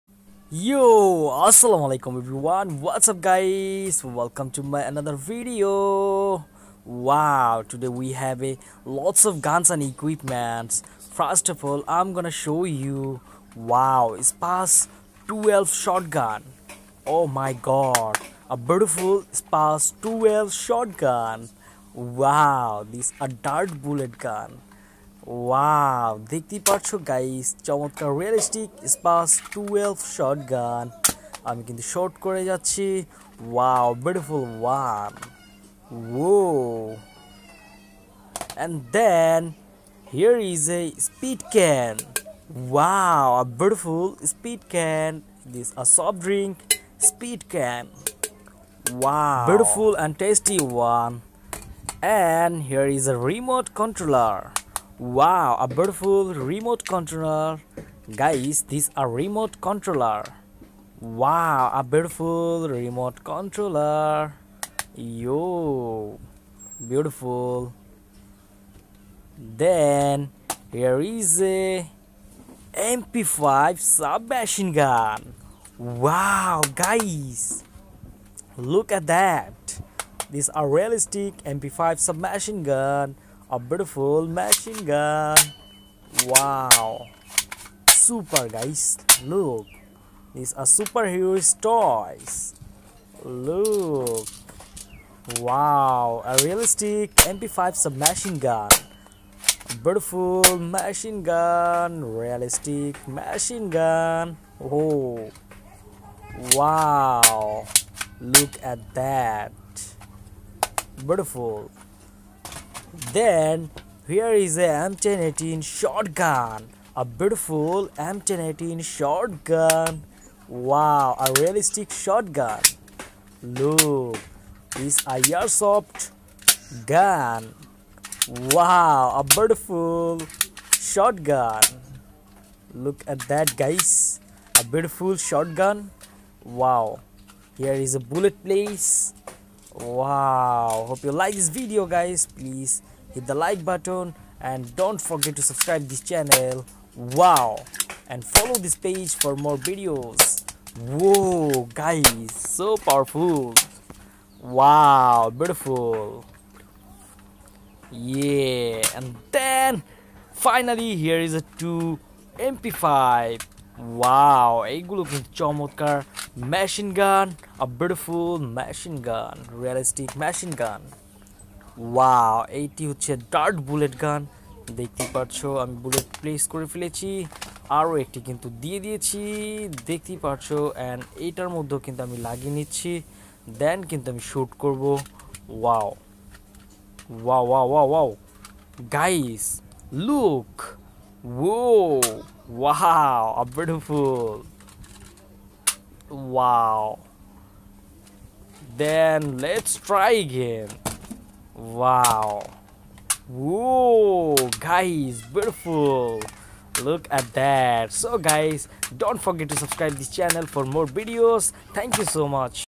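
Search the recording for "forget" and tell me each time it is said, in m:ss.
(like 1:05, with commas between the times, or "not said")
2:24, 3:29.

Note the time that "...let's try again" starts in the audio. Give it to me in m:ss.
3:19.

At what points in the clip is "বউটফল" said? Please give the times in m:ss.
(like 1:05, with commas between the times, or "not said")
0:34, 0:43, 0:49, 3:13.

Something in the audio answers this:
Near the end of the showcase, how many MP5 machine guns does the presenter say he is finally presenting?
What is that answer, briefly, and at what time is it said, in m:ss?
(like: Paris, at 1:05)
2, at 2:41.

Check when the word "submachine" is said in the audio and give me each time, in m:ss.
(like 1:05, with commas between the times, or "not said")
1:13, 1:21, 1:37.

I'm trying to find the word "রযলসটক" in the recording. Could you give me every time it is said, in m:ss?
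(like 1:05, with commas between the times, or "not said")
0:28.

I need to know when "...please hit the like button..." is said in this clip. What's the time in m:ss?
2:22.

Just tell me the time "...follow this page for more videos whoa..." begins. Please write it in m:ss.
2:28.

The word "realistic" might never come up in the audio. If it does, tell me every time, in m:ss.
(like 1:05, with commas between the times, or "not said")
1:20, 1:36, 1:42, 2:01, 2:49.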